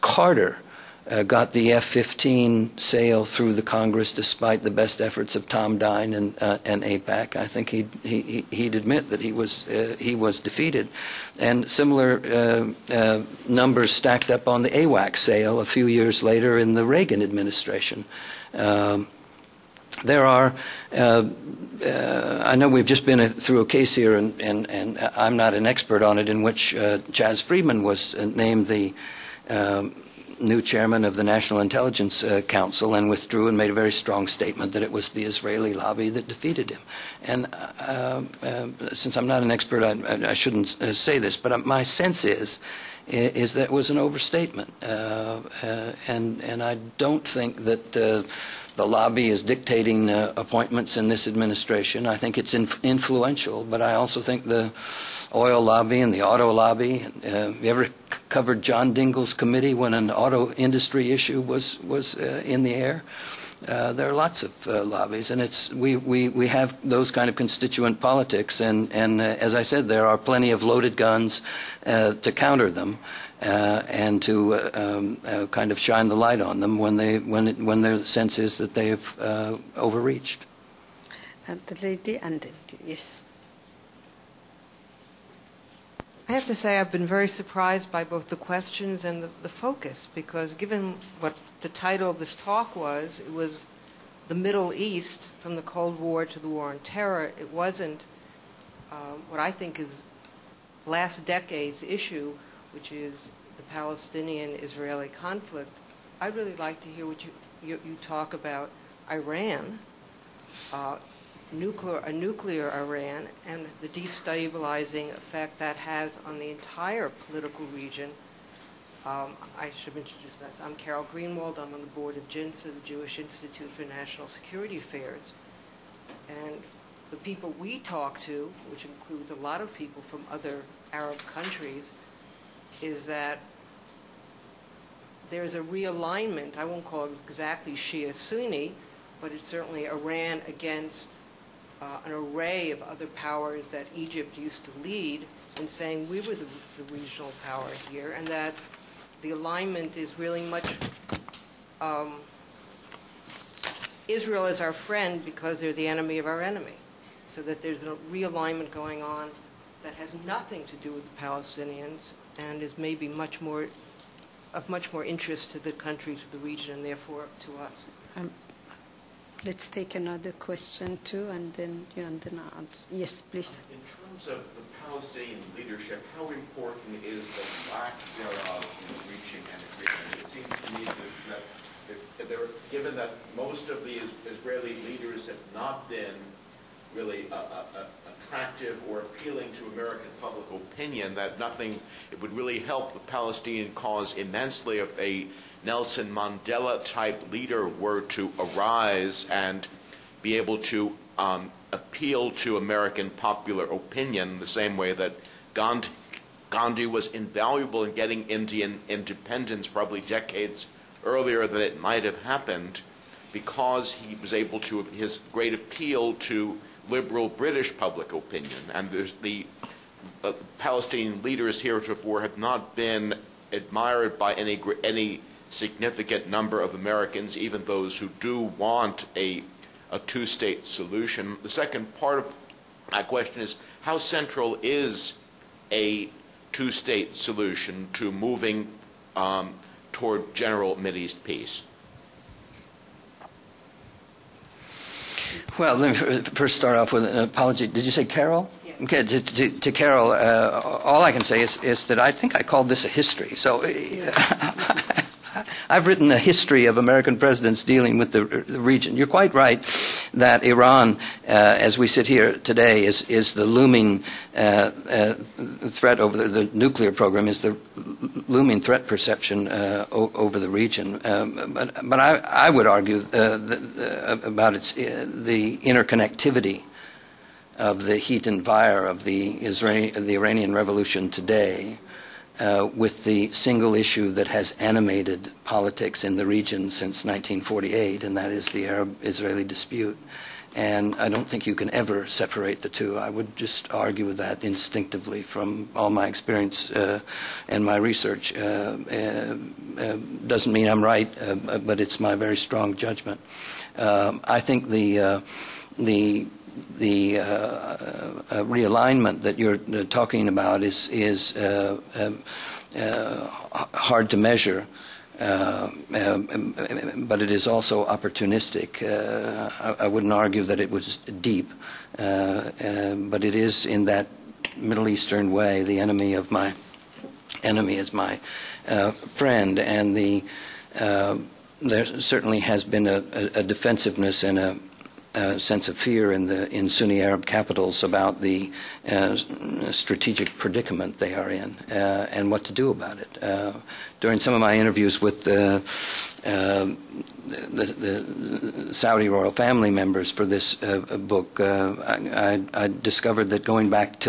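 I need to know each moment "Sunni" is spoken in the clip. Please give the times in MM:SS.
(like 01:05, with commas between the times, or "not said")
02:18, 05:36.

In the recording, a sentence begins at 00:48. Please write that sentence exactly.
the lobby is dictating appointments in this administration.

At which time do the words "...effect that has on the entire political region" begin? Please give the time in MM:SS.
01:55.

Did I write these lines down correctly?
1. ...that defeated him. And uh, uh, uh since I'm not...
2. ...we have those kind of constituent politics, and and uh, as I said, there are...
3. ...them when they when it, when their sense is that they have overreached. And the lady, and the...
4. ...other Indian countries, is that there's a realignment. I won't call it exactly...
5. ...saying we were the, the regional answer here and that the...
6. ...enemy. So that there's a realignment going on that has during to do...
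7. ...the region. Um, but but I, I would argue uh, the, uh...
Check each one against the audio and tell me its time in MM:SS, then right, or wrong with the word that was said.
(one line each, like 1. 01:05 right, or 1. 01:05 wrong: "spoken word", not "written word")
1. 00:36 right
2. 01:06 right
3. 01:16 right
4. 02:10 wrong: "Arab", not "Indian"
5. 02:25 wrong: "power", not "answer"
6. 02:36 wrong: "nothing", not "during"
7. 04:30 right.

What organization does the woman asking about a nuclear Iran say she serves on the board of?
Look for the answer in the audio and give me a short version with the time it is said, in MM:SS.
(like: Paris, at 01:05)
JINSA, at 02:02.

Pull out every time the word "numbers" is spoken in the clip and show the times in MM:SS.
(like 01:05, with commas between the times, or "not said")
00:13, 03:46.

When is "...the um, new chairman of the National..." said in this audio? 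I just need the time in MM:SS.
00:28.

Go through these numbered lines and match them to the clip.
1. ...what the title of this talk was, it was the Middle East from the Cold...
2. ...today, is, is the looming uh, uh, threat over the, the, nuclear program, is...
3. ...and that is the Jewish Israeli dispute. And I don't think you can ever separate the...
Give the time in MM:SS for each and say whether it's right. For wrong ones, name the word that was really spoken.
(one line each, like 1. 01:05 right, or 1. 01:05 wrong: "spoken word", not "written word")
1. 01:31 right
2. 04:22 right
3. 04:48 wrong: "Arab", not "Jewish".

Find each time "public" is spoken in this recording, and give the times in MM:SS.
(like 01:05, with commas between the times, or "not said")
03:10, 03:37.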